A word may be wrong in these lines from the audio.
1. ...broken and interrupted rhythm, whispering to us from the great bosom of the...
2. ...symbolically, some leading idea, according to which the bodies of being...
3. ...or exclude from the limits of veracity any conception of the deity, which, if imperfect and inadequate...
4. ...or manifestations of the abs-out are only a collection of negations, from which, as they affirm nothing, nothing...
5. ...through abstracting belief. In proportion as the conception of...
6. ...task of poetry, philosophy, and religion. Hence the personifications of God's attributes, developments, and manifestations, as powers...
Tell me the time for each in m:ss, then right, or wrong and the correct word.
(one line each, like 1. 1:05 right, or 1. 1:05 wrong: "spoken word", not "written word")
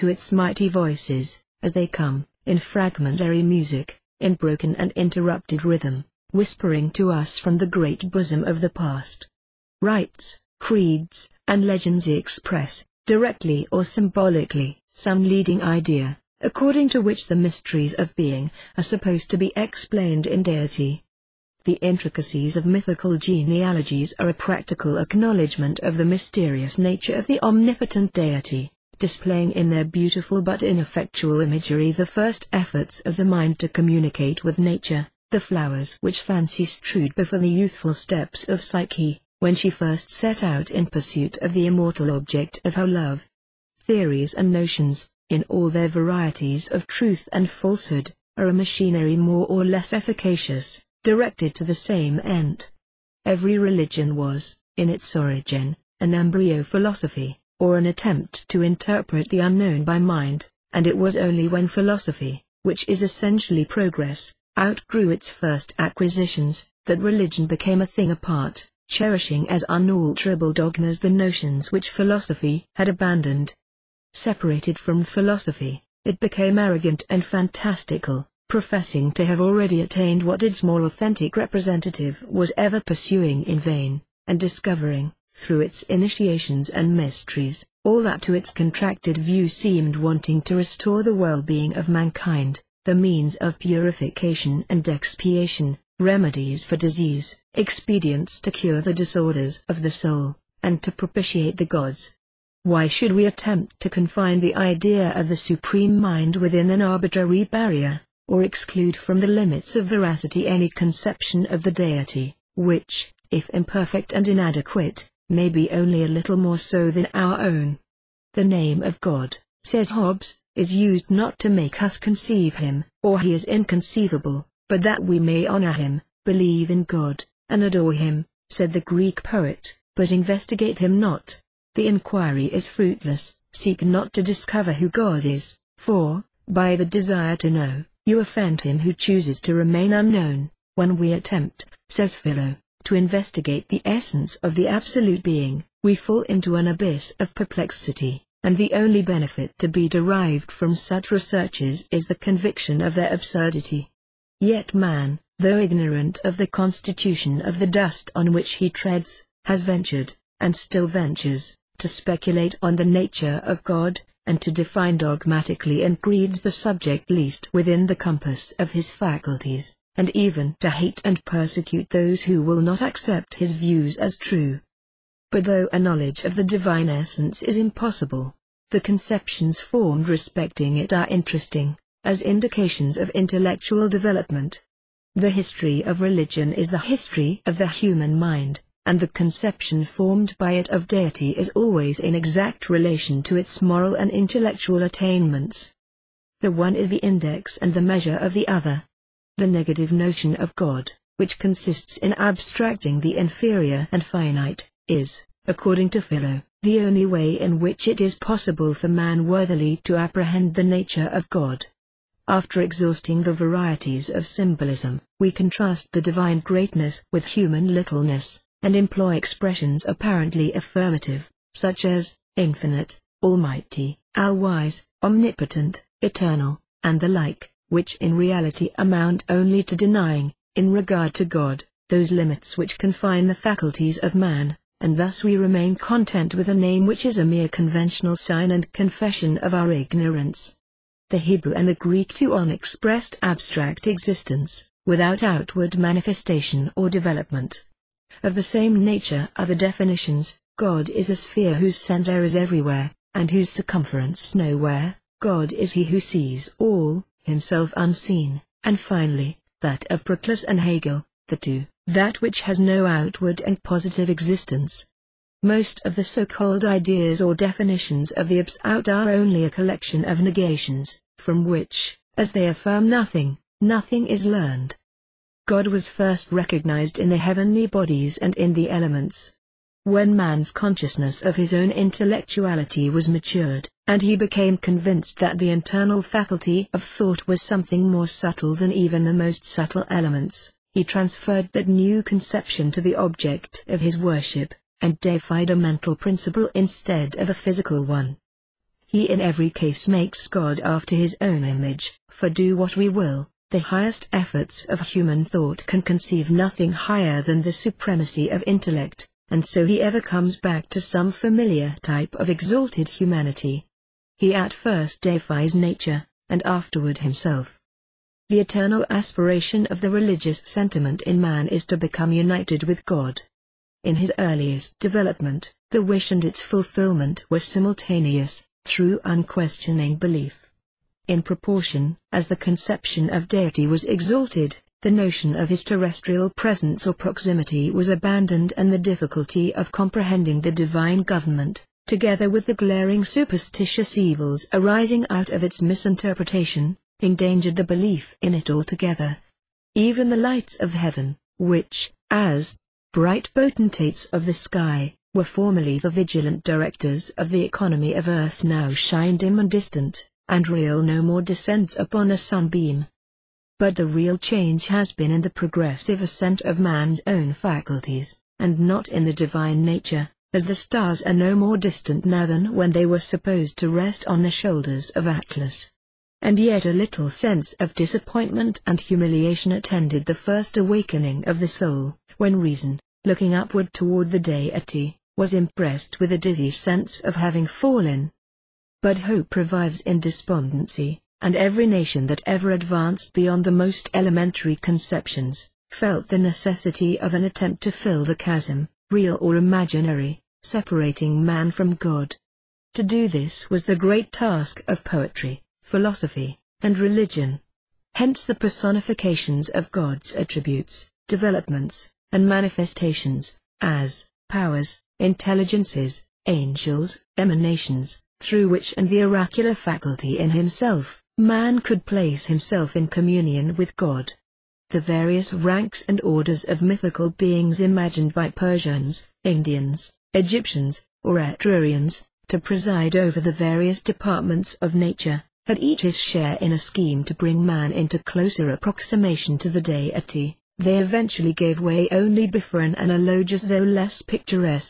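1. 0:04 right
2. 0:13 wrong: "mysteries", not "bodies"
3. 1:48 right
4. 4:27 wrong: "definitions", not "manifestations"
5. 5:28 wrong: "unquestioning", not "abstracting"
6. 6:44 right.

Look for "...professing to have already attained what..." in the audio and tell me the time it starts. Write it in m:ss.
1:18.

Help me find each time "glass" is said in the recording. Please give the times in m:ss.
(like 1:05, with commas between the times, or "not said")
not said.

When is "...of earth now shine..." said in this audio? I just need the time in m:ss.
5:57.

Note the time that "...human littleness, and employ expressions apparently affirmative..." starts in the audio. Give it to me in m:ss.
3:37.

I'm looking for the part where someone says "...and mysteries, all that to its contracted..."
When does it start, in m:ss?
1:26.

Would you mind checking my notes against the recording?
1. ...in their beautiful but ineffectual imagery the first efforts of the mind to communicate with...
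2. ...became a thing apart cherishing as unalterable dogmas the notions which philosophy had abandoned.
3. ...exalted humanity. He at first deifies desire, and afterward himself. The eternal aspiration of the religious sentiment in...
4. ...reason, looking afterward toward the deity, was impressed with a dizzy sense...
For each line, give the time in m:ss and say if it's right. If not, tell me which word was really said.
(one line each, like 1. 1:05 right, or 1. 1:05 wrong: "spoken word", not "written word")
1. 0:29 right
2. 1:07 right
3. 5:12 wrong: "nature", not "desire"
4. 6:22 wrong: "upward", not "afterward".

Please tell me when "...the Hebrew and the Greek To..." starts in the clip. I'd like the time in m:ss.
4:01.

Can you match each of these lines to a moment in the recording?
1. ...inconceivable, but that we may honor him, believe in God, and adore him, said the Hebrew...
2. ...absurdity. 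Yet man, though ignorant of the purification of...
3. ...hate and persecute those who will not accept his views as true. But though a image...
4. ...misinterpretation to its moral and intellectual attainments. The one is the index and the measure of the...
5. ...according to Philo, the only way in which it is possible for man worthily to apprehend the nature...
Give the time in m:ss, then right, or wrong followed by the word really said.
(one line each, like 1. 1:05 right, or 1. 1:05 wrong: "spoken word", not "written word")
1. 2:03 wrong: "Greek", not "Hebrew"
2. 2:33 wrong: "constitution", not "purification"
3. 2:50 wrong: "knowledge", not "image"
4. 3:12 wrong: "relation", not "misinterpretation"
5. 3:25 right.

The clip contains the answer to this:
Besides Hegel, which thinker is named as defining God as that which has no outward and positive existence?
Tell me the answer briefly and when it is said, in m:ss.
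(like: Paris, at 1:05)
Proclus, at 4:20.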